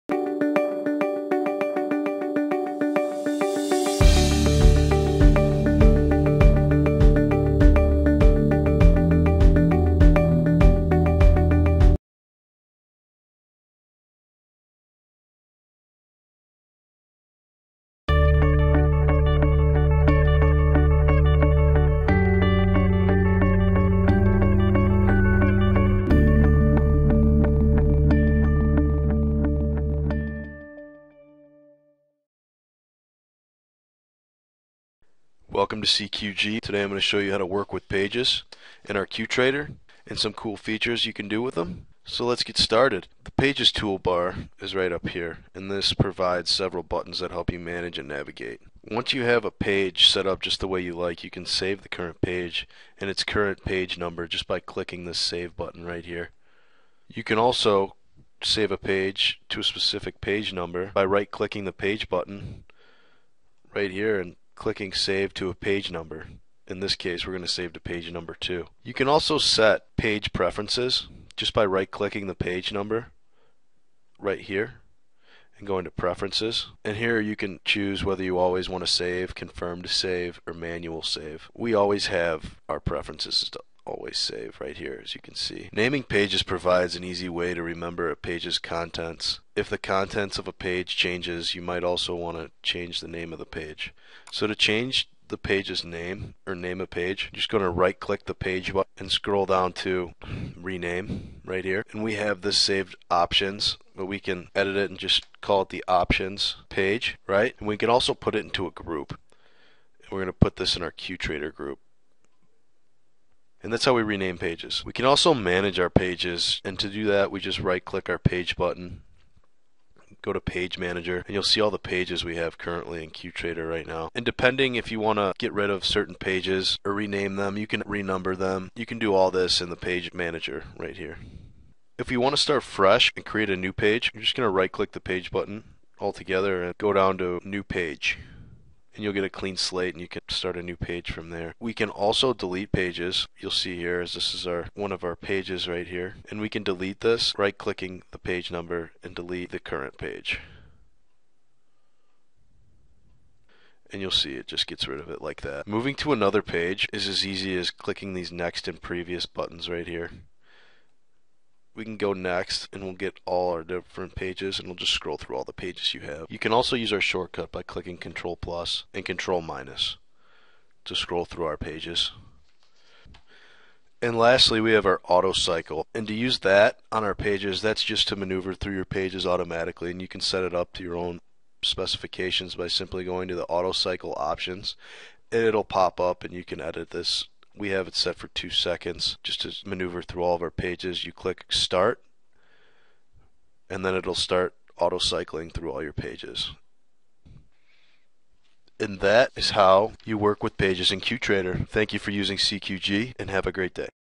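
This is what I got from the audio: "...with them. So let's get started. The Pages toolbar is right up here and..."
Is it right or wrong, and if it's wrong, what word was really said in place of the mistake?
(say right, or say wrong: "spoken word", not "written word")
right.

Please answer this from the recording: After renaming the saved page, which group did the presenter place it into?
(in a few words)
QTrader group.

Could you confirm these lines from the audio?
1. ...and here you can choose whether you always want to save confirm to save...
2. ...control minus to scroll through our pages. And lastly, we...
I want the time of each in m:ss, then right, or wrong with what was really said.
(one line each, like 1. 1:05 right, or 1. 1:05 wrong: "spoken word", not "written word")
1. 1:16 right
2. 2:49 right.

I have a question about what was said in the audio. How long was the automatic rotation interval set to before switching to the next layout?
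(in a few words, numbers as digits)
2 seconds.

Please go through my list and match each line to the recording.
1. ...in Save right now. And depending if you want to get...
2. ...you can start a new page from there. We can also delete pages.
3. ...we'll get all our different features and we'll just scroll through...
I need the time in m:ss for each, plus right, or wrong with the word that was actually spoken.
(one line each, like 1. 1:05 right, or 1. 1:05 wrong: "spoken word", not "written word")
1. 2:03 wrong: "QTrader", not "Save"
2. 2:20 right
3. 2:42 wrong: "pages", not "features".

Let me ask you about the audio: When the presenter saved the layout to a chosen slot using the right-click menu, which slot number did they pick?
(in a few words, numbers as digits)
2.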